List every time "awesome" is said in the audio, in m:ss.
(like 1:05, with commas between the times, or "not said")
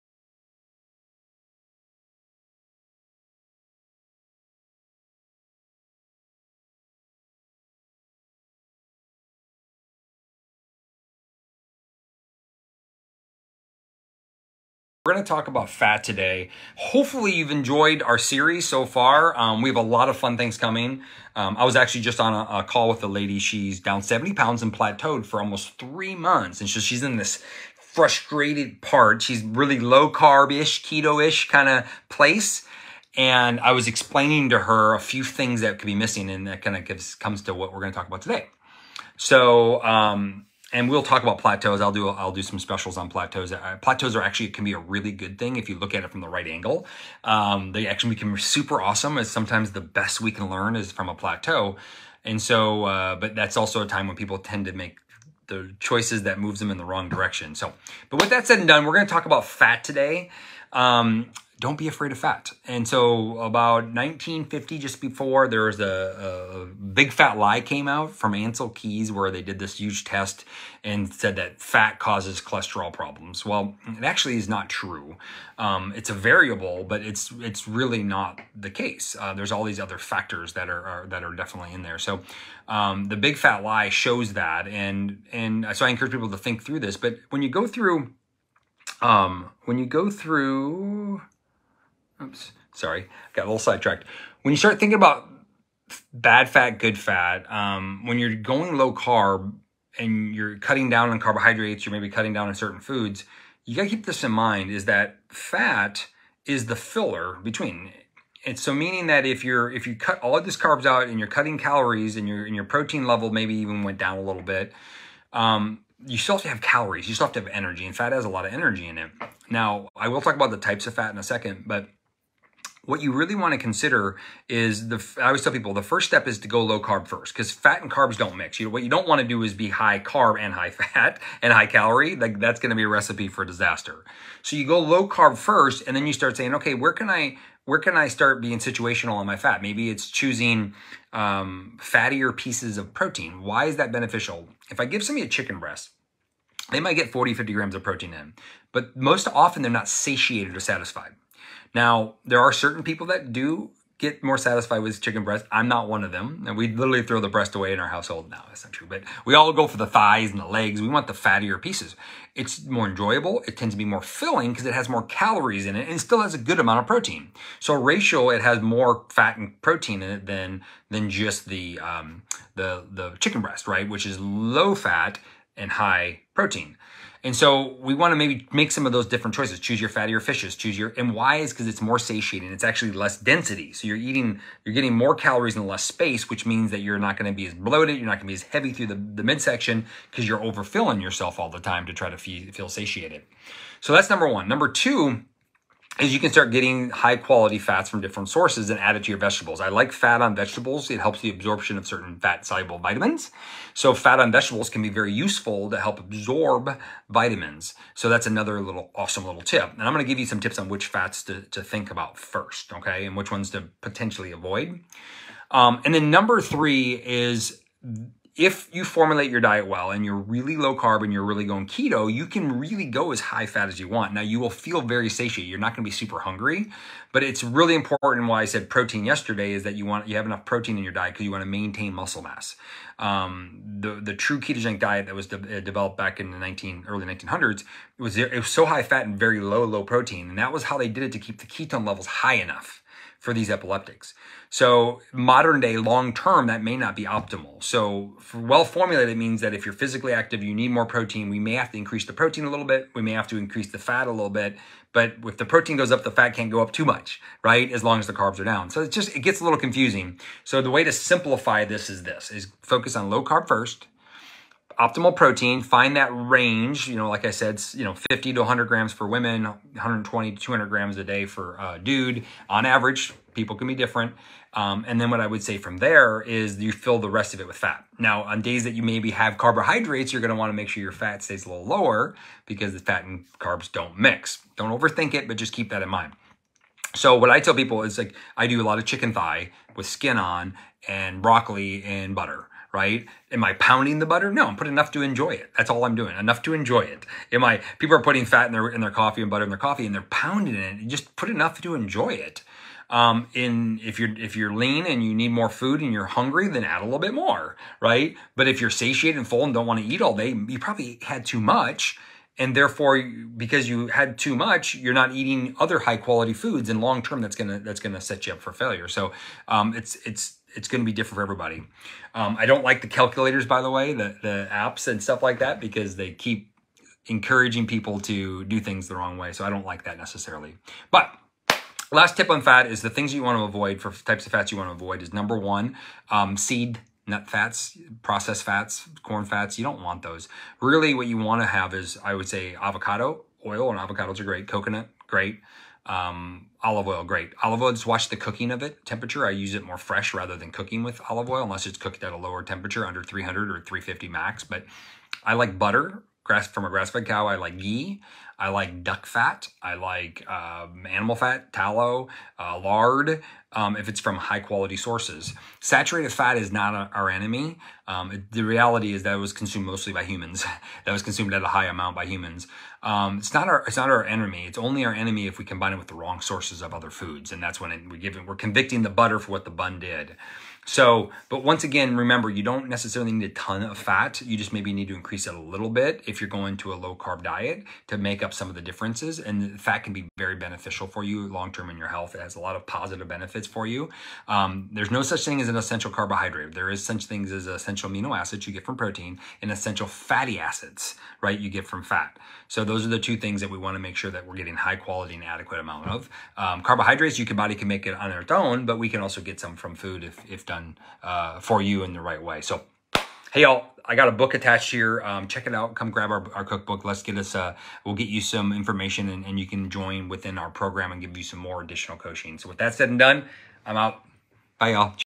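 0:48, 3:28.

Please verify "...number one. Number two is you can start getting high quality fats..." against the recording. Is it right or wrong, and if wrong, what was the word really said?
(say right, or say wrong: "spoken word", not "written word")
right.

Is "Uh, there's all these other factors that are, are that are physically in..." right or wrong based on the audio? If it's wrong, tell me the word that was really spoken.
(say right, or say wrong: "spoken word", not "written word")
wrong: "definitely", not "physically".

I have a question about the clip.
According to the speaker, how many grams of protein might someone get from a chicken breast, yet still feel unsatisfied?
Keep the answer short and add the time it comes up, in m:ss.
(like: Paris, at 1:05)
40-50 grams, at 2:27.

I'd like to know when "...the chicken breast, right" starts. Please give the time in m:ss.
2:52.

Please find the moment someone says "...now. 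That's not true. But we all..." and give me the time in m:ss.
2:38.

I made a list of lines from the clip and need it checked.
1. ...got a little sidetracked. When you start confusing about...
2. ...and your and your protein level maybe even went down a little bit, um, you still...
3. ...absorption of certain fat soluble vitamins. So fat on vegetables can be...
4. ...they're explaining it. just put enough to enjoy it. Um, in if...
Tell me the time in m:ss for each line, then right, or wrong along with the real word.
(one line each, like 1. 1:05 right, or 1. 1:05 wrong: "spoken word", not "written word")
1. 1:33 wrong: "thinking", not "confusing"
2. 1:52 right
3. 3:21 right
4. 4:59 wrong: "pounding", not "explaining".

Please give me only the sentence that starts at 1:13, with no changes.
Well, it actually is not true.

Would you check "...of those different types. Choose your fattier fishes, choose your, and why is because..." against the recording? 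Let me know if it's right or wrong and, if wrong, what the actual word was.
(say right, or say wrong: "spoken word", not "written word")
wrong: "choices", not "types".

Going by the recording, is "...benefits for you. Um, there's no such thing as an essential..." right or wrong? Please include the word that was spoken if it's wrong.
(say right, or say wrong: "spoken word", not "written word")
right.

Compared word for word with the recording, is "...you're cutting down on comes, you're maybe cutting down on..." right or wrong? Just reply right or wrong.
wrong.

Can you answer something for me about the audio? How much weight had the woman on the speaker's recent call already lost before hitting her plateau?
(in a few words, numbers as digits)
70 pounds.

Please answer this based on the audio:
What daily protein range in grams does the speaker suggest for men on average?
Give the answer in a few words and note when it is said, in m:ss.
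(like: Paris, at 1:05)
120 to 200 grams, at 4:29.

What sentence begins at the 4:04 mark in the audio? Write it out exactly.
So modern day, long term, that may not be optimal.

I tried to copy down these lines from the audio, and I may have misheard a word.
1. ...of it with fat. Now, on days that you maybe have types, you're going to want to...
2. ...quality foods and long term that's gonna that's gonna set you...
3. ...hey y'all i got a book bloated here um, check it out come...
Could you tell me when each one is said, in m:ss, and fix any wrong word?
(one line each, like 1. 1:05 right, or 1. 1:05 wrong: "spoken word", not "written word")
1. 4:37 wrong: "carbohydrates", not "types"
2. 5:15 right
3. 6:53 wrong: "attached", not "bloated".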